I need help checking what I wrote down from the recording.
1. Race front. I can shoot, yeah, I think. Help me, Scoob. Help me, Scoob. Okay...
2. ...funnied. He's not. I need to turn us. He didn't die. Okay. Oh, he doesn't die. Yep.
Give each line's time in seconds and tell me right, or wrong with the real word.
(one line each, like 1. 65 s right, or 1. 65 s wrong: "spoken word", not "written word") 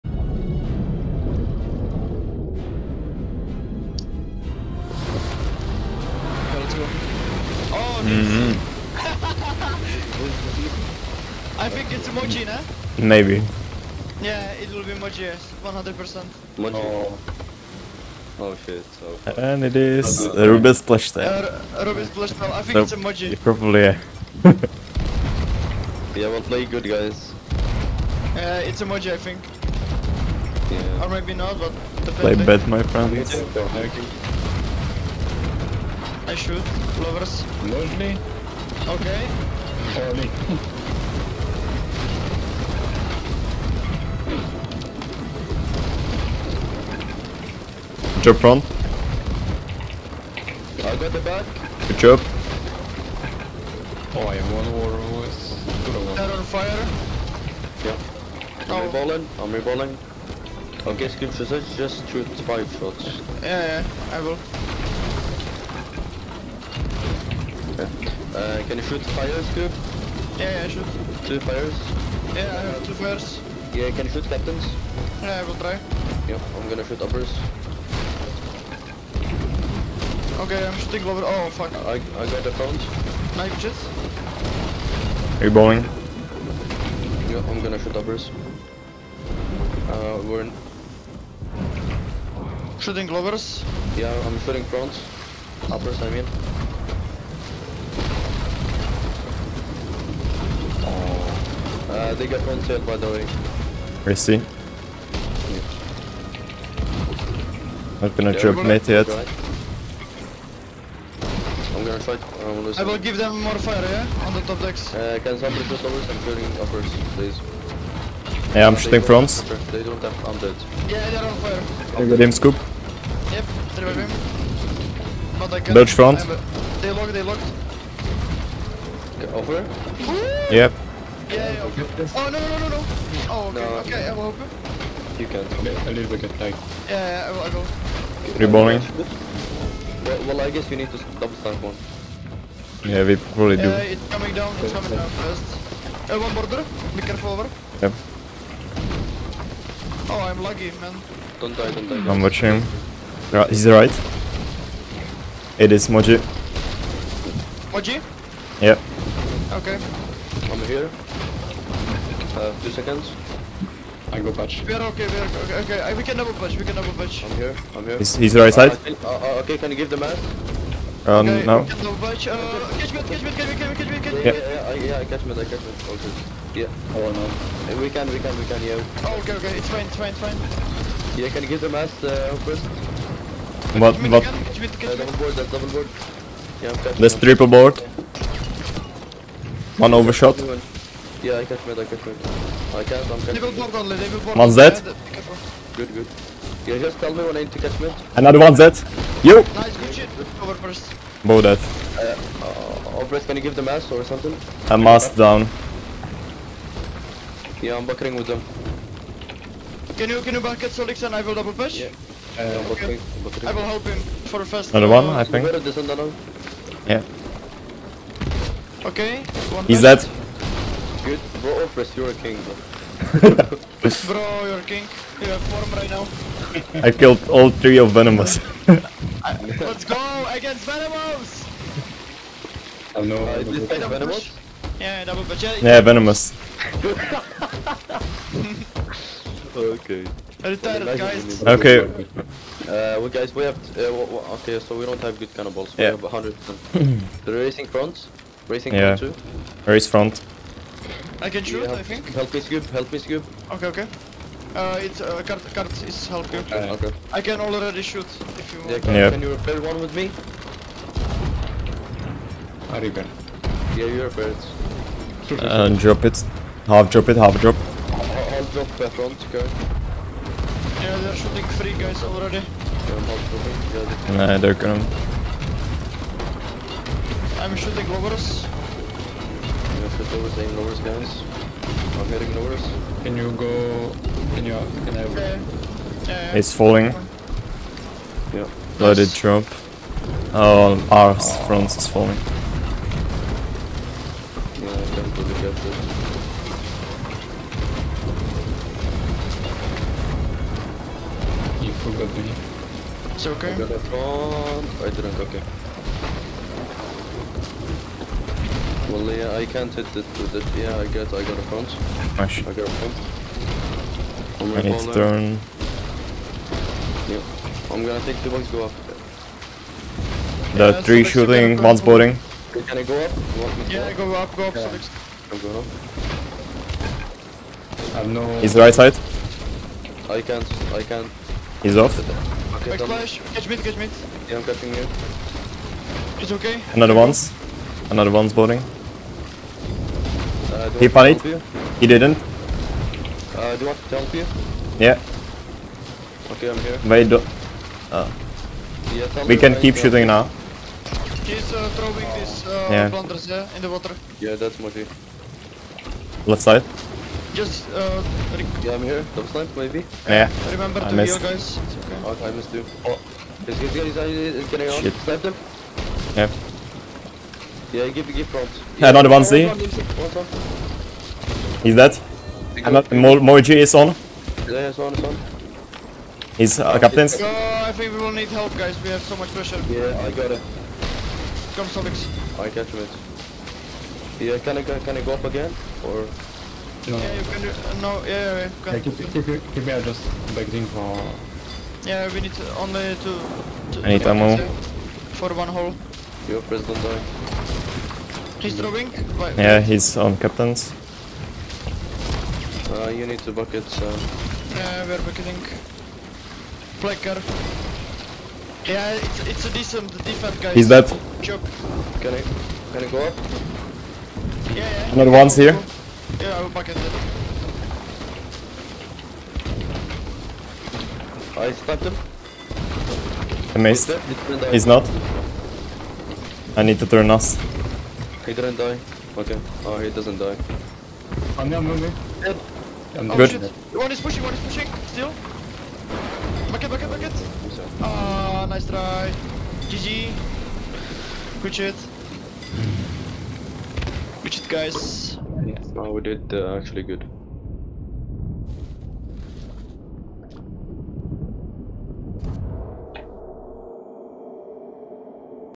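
1. 249 s right
2. 423 s wrong: "missed", not "funnied".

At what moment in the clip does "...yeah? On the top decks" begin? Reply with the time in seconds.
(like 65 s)
113 s.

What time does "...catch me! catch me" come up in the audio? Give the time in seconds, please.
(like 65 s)
173 s.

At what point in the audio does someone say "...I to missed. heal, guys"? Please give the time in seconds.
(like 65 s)
360 s.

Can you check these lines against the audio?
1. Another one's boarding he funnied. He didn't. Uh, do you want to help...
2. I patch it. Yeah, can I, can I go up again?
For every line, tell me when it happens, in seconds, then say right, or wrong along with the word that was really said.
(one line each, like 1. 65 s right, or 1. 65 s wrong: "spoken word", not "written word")
1. 337 s right
2. 382 s wrong: "catch", not "patch".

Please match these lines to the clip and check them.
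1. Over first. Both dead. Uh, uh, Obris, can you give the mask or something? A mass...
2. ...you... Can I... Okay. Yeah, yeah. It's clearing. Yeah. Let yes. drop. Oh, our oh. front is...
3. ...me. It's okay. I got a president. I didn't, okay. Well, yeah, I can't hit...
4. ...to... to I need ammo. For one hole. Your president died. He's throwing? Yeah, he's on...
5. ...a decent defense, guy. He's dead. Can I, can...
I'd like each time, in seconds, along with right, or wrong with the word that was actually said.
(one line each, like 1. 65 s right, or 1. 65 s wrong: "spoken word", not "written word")
1. 200 s right
2. 284 s wrong: "falling", not "clearing"
3. 302 s wrong: "front", not "president"
4. 393 s right
5. 409 s right.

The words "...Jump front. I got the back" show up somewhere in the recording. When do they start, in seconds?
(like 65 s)
48 s.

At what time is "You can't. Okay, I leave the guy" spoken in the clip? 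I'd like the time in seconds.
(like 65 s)
135 s.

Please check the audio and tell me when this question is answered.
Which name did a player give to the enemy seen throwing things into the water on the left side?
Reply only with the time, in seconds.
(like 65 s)
354 s.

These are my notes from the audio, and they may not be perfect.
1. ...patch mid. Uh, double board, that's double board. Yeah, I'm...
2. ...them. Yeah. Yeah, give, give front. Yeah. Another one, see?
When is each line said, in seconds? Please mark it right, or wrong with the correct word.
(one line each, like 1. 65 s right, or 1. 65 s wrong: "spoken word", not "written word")
1. 184 s wrong: "catch", not "patch"
2. 365 s right.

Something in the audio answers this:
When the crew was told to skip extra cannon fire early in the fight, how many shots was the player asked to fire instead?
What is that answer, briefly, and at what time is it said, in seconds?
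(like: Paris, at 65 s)
5, at 62 s.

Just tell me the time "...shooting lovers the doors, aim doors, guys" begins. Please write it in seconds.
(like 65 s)
277 s.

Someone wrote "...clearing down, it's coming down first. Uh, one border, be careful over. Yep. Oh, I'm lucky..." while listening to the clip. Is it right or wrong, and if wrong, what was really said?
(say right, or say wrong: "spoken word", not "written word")
wrong: "coming", not "clearing".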